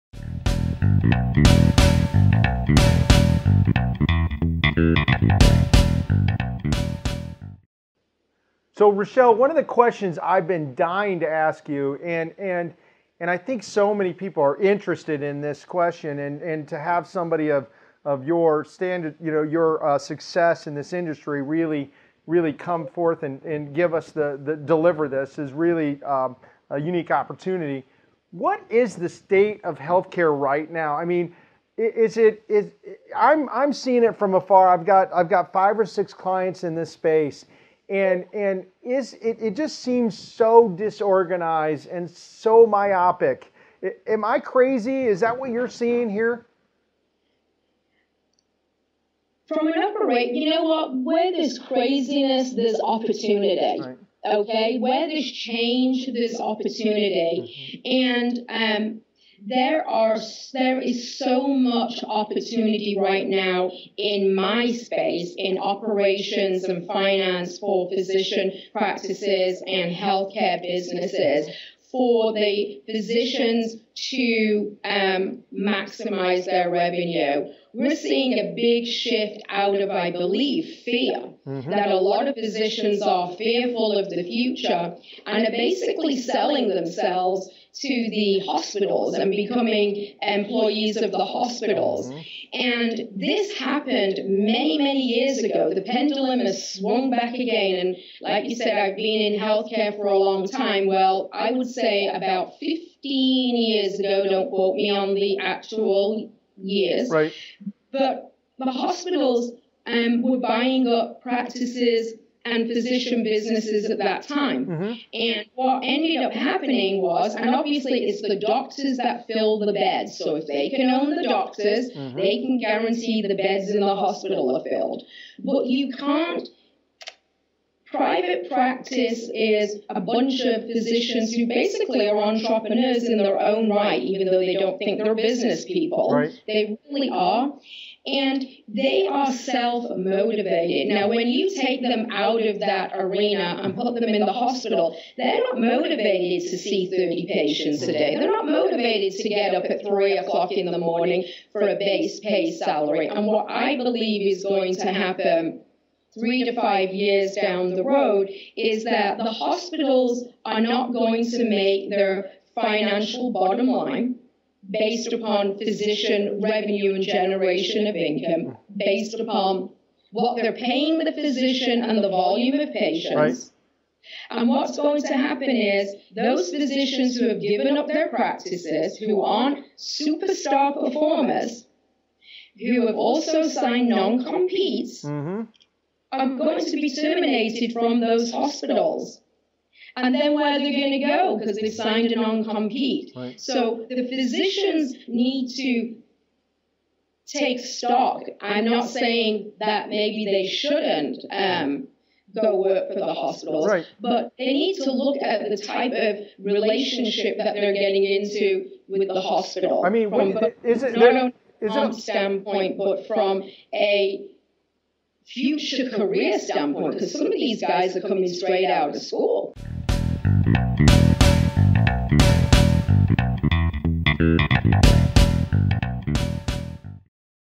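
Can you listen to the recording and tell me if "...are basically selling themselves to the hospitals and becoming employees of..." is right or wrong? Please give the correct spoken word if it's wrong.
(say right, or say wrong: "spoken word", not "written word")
right.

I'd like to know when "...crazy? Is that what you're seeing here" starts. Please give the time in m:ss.
0:44.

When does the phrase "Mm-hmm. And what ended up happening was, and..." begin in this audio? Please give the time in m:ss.
1:54.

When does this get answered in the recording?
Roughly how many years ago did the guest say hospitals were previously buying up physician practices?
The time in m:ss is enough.
1:42.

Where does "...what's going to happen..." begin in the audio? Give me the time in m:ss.
2:54.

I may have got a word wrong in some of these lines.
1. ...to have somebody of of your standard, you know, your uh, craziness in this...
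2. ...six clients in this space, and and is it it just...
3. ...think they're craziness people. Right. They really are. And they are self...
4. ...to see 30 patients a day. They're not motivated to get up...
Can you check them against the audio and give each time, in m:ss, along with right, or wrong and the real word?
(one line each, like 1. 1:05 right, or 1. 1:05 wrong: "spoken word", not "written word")
1. 0:16 wrong: "success", not "craziness"
2. 0:35 right
3. 2:14 wrong: "business", not "craziness"
4. 2:26 right.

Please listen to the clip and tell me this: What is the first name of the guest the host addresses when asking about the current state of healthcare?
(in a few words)
Rochelle.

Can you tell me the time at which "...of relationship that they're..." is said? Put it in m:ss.
3:25.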